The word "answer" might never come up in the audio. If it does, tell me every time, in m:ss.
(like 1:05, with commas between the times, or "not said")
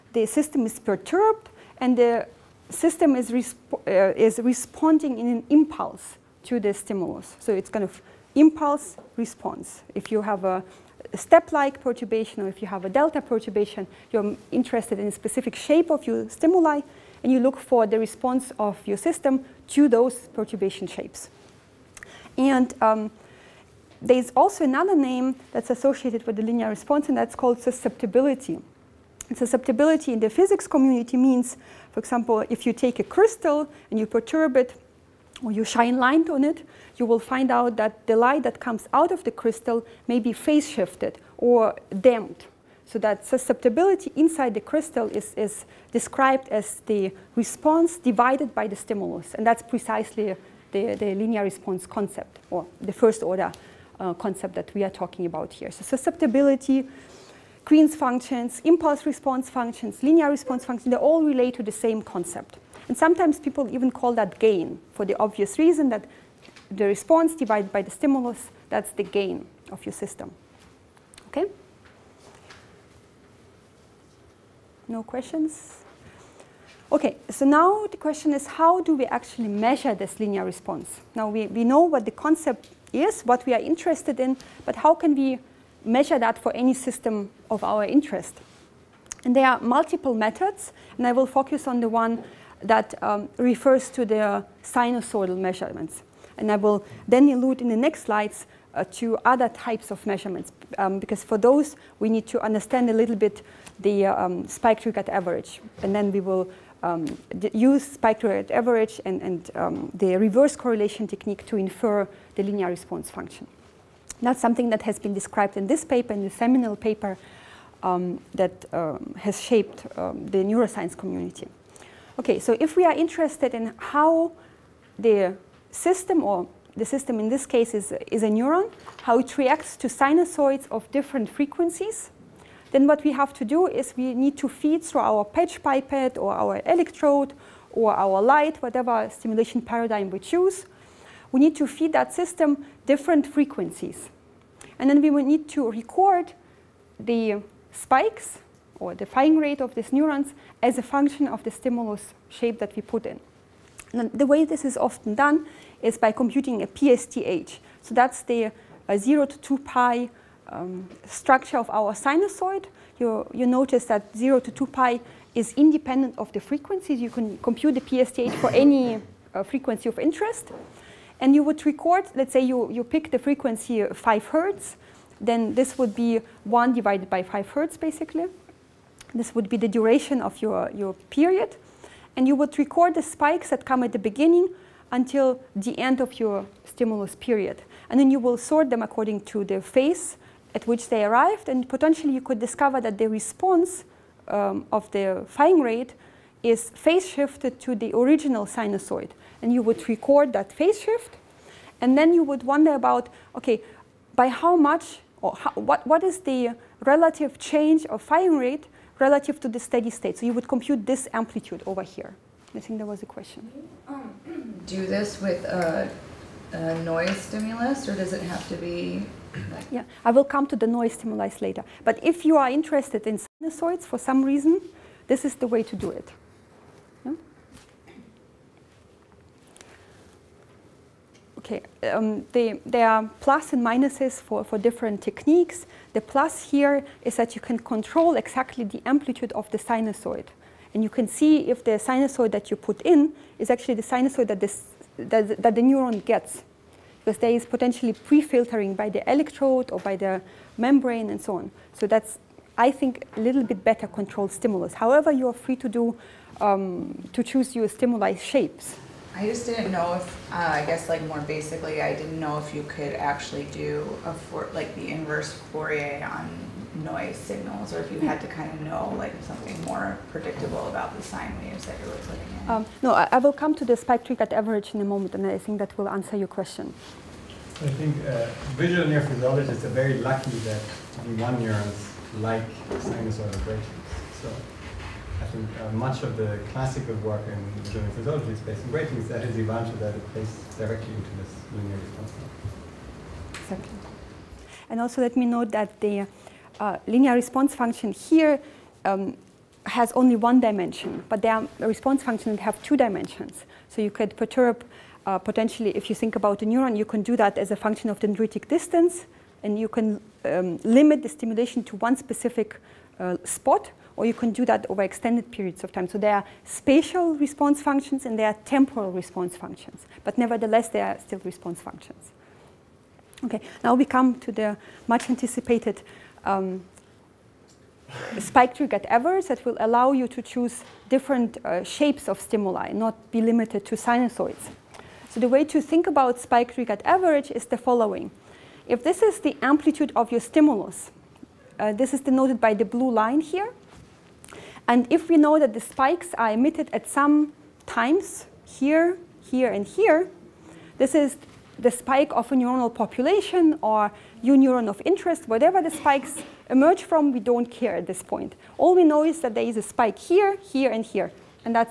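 4:35.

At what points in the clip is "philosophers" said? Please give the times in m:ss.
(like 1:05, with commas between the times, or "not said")
not said.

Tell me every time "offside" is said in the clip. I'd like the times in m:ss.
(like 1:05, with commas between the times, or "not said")
not said.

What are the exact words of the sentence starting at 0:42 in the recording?
So that susceptibility inside the crystal is, is described as the response divided by the stimulus.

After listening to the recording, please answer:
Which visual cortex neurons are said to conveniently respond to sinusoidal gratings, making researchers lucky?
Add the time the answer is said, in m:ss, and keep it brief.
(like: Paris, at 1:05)
V1 neurons, at 4:41.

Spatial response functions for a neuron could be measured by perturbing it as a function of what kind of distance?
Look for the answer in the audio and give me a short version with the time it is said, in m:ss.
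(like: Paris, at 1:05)
Dendritic distance, at 5:07.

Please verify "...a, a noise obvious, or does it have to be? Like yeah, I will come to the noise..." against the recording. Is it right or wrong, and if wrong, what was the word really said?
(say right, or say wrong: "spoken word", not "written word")
wrong: "stimulus", not "obvious".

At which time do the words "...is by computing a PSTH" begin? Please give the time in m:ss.
2:35.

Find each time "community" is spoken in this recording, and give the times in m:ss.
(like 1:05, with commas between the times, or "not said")
0:30, 2:00.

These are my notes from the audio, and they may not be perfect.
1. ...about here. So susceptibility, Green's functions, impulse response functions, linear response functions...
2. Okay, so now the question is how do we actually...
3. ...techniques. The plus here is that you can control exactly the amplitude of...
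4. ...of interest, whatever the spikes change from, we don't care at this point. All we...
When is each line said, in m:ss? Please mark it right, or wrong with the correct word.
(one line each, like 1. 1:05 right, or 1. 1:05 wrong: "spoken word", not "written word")
1. 0:55 right
2. 1:16 right
3. 3:55 right
4. 5:54 wrong: "emerge", not "change".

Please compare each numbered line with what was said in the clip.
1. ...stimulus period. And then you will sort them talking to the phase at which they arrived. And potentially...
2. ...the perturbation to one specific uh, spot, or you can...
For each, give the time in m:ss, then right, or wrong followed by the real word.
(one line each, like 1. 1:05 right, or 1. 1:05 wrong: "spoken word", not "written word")
1. 3:06 wrong: "according", not "talking"
2. 5:11 wrong: "stimulation", not "perturbation".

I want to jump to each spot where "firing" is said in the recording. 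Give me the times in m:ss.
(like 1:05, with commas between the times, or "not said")
2:29, 3:15, 3:28.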